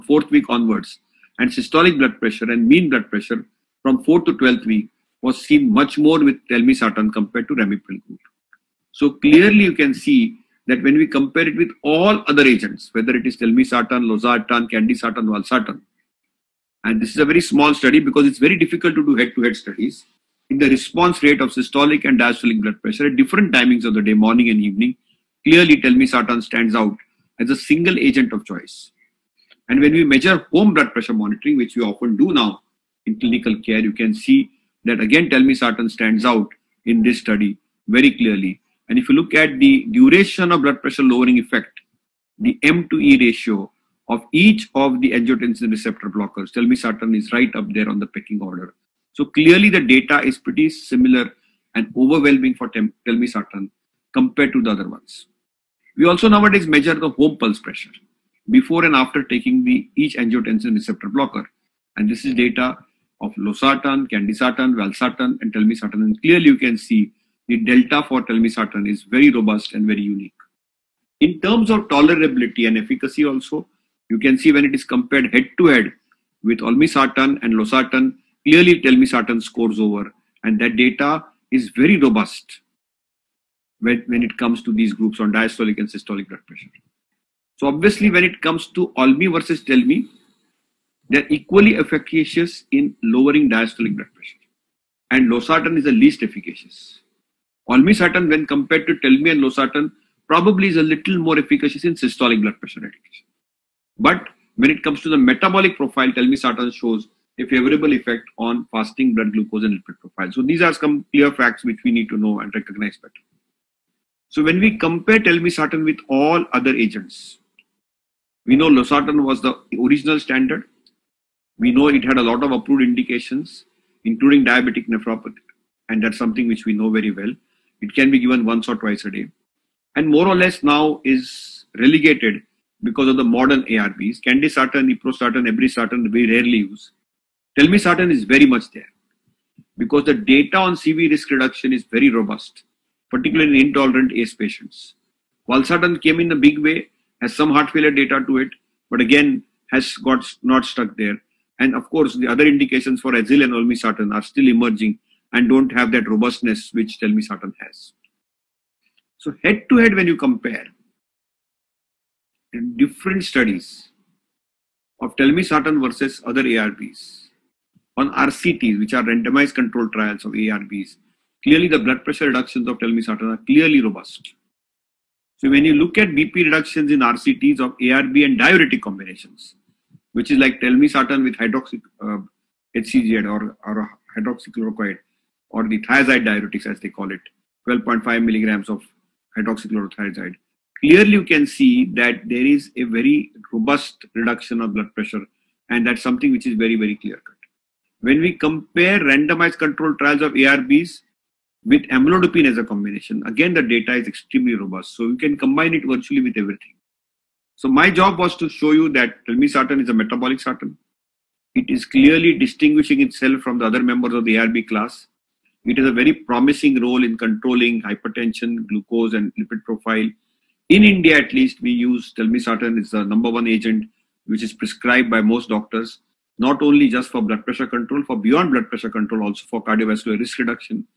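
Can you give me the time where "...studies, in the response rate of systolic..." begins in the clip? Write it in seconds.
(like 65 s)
19 s.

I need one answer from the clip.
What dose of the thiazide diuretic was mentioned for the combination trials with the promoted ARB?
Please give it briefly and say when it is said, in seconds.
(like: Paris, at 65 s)
12.5 milligrams, at 187 s.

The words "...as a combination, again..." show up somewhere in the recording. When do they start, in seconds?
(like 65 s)
202 s.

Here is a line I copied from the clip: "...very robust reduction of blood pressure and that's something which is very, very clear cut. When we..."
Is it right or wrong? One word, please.
right.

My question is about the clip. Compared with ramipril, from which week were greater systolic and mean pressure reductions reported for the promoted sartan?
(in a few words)
12th week.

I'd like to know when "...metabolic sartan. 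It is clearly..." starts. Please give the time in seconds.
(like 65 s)
209 s.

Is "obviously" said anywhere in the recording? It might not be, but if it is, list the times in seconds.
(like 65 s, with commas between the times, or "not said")
87 s.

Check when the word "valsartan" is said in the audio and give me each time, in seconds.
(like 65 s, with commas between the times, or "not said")
15 s, 64 s, 145 s.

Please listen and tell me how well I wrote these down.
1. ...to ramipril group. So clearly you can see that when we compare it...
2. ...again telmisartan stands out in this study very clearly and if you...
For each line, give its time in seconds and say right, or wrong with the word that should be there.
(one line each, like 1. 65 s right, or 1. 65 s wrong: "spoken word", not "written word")
1. 7 s right
2. 35 s right.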